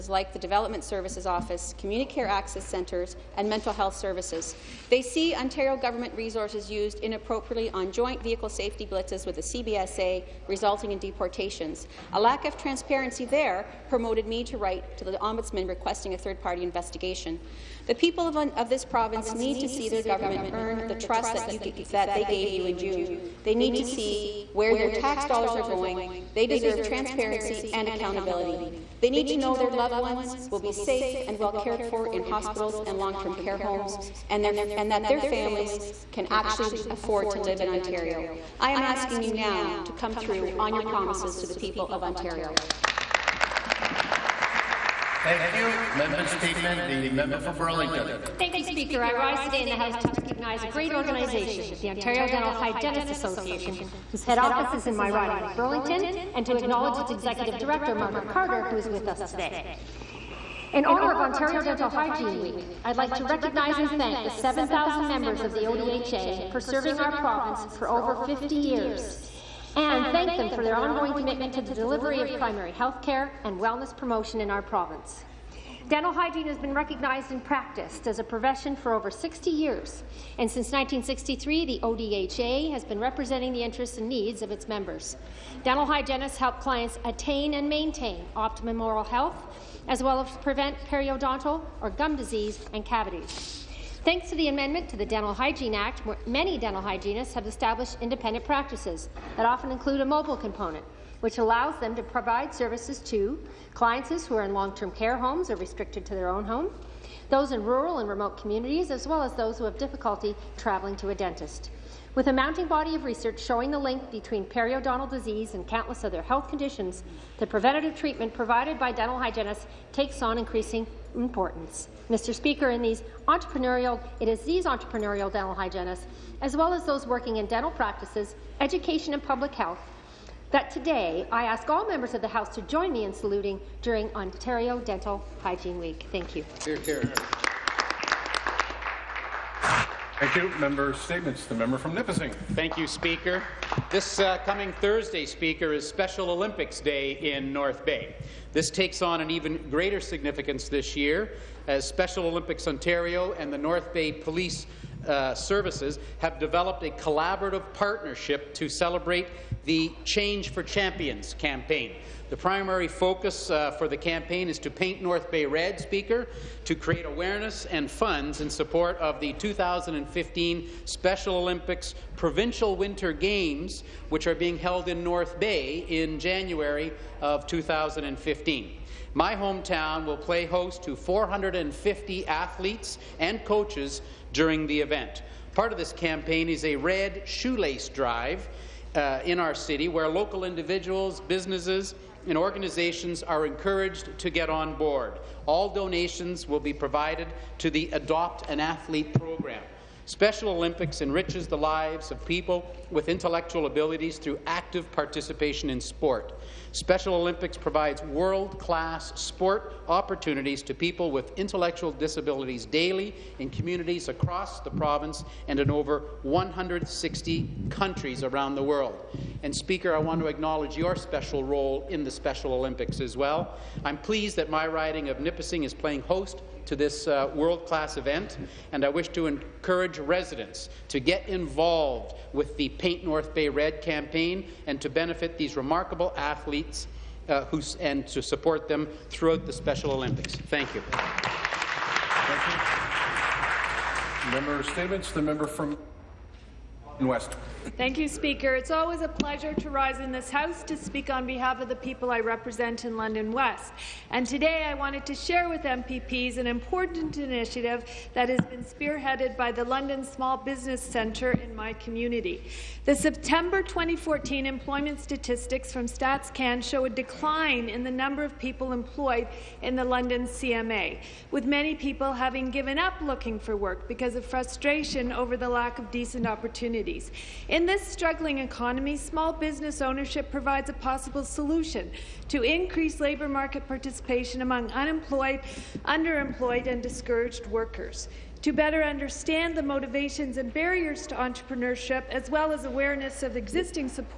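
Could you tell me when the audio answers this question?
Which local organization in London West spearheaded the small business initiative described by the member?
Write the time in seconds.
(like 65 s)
259 s.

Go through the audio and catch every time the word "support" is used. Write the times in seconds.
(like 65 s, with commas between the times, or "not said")
168 s, 238 s.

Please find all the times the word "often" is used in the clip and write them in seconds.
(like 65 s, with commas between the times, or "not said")
99 s.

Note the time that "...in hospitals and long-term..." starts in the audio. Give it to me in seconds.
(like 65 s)
32 s.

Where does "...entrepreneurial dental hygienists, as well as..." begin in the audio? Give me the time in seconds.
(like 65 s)
124 s.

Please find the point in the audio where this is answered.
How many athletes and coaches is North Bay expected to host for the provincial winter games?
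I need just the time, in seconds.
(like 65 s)
180 s.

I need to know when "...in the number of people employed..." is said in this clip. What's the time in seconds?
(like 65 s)
267 s.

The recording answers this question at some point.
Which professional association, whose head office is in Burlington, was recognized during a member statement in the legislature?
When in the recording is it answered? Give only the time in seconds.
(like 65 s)
51 s.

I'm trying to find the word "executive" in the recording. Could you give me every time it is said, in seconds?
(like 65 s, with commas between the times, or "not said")
57 s.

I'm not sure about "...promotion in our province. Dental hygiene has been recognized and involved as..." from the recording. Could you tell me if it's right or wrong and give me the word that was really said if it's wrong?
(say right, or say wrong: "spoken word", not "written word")
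wrong: "practiced", not "involved".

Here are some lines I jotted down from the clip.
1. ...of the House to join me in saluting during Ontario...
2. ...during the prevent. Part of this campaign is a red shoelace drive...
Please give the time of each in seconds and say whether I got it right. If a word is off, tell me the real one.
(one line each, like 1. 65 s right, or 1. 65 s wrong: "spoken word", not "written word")
1. 132 s right
2. 184 s wrong: "event", not "prevent".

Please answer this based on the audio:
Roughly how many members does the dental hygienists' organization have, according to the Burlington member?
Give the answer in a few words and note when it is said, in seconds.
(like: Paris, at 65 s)
7,000, at 64 s.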